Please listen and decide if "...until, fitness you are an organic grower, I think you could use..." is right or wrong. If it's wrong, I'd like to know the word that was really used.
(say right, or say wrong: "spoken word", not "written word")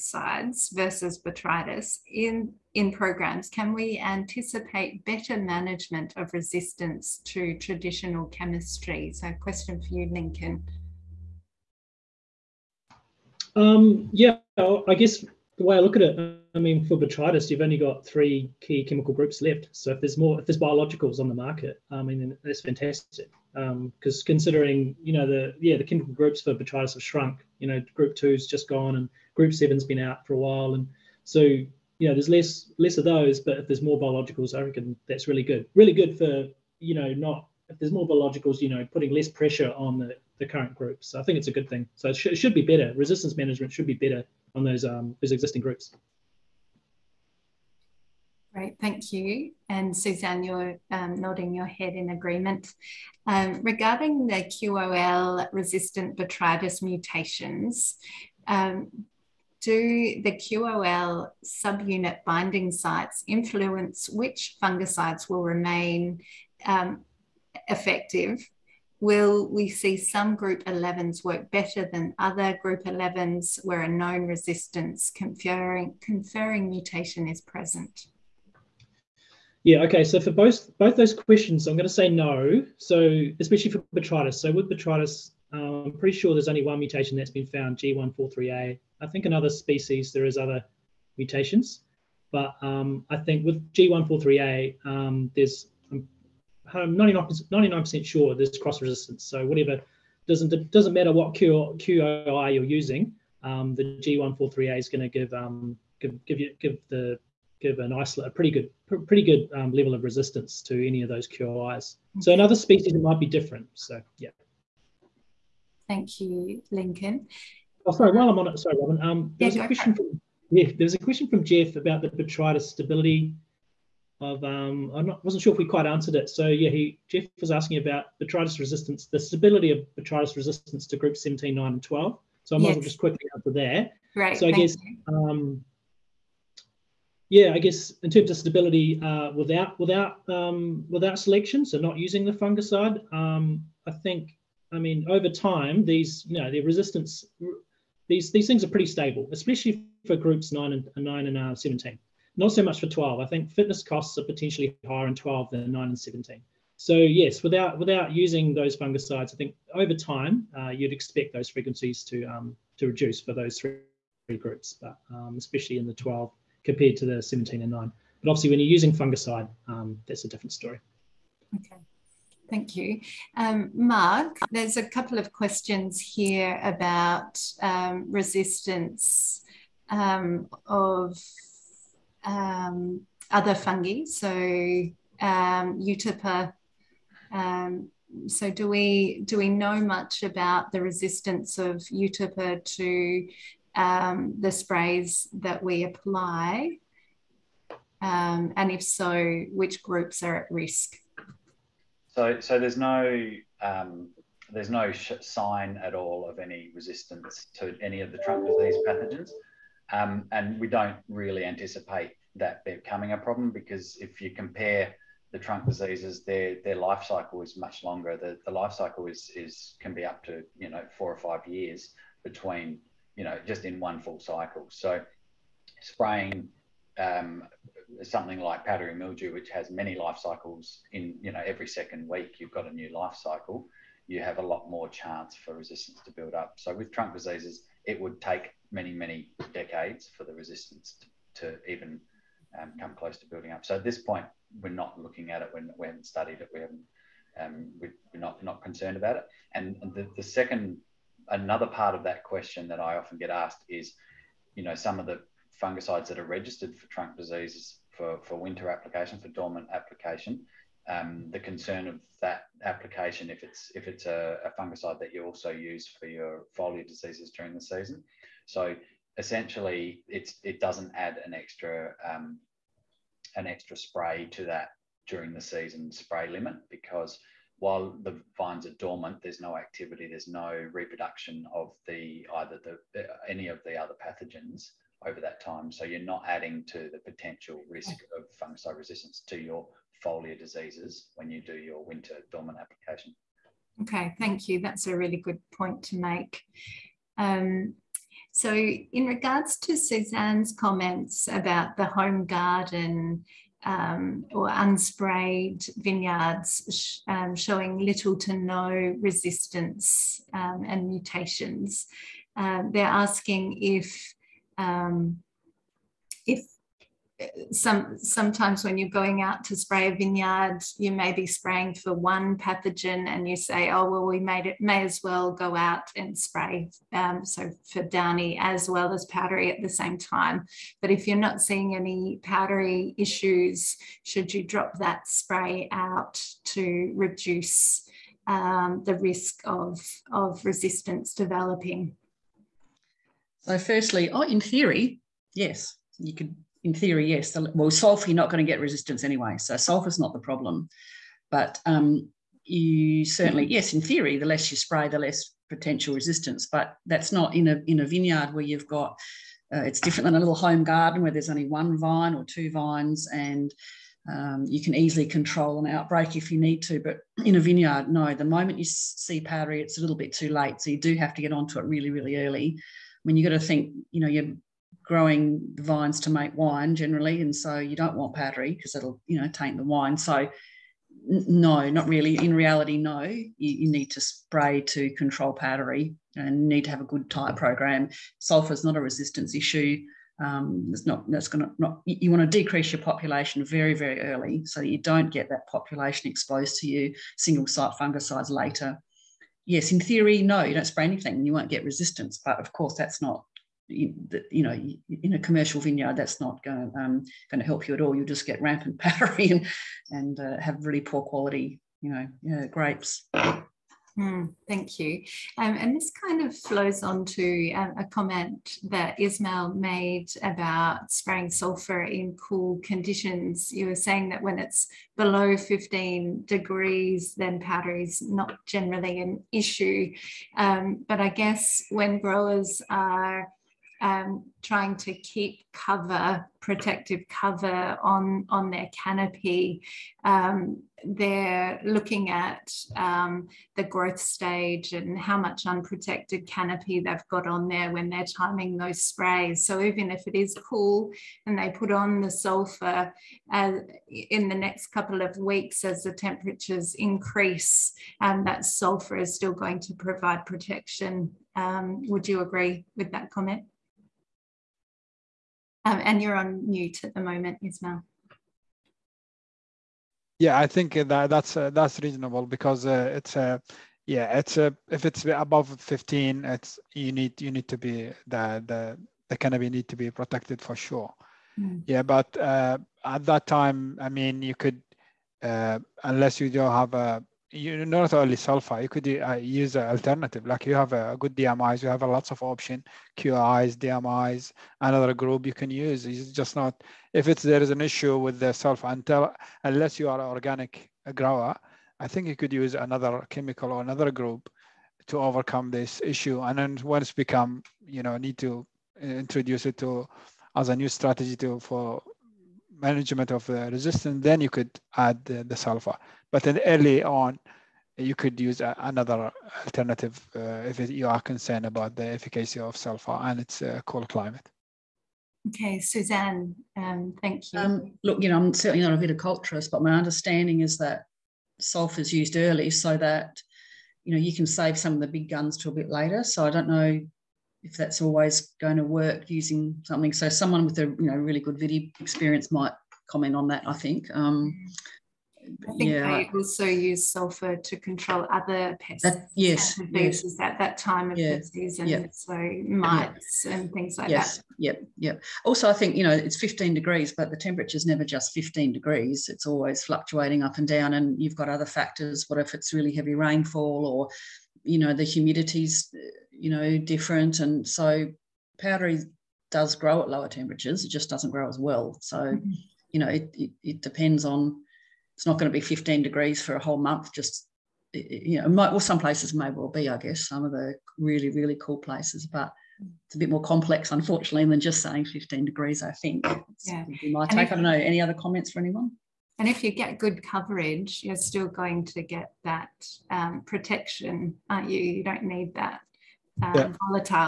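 wrong: "unless", not "fitness".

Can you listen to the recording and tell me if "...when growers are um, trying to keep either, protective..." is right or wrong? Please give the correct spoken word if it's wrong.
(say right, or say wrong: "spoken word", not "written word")
wrong: "cover", not "either".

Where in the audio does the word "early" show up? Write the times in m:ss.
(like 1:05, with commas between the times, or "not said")
6:12, 6:34, 8:36, 8:52.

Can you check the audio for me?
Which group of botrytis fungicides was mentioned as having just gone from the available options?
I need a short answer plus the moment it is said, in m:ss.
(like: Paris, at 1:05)
group two, at 0:27.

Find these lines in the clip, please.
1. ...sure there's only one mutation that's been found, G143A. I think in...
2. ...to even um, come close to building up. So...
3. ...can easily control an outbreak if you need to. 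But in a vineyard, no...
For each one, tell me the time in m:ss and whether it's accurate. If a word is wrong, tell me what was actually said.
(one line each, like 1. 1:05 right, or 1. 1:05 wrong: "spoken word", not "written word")
1. 1:26 right
2. 4:01 right
3. 6:04 right.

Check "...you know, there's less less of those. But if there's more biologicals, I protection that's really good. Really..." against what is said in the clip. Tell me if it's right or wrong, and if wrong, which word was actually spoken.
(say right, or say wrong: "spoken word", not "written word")
wrong: "reckon", not "protection".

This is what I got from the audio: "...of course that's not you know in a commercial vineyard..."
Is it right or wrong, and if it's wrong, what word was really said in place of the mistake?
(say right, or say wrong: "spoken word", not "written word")
right.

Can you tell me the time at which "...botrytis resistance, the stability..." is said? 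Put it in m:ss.
2:08.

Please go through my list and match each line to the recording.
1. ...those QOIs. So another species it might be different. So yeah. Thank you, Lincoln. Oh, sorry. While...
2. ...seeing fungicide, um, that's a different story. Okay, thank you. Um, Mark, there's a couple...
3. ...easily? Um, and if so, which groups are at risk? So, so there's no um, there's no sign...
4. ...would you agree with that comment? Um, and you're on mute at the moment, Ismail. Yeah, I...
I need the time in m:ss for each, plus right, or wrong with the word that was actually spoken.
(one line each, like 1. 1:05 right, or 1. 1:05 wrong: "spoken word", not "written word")
1. 1:51 right
2. 2:48 wrong: "using", not "seeing"
3. 3:15 wrong: "apply", not "easily"
4. 7:41 right.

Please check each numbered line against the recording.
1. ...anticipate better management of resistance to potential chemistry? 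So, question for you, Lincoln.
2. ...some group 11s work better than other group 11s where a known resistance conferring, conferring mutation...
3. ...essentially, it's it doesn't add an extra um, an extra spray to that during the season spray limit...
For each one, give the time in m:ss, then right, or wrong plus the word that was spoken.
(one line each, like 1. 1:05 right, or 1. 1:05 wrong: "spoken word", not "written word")
1. 0:03 wrong: "traditional", not "potential"
2. 1:09 right
3. 4:29 right.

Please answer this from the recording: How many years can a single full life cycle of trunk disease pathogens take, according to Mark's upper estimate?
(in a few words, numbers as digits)
4 or 5 years.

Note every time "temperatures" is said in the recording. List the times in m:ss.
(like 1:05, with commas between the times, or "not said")
7:35, 9:17, 9:30.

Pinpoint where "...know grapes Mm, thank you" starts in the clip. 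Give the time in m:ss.
6:52.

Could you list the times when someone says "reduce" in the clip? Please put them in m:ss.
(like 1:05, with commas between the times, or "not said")
2:42, 5:36.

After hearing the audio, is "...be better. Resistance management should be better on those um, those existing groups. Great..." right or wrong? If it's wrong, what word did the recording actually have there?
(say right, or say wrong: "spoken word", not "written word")
right.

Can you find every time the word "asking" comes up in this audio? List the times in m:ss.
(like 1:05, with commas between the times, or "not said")
2:07, 5:13.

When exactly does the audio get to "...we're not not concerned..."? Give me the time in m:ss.
4:07.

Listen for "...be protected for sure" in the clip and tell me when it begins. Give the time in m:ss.
7:59.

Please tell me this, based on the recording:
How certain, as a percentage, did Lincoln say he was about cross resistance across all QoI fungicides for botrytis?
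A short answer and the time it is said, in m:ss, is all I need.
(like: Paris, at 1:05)
99 percent, at 1:36.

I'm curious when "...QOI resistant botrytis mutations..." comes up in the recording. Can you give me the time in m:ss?
0:54.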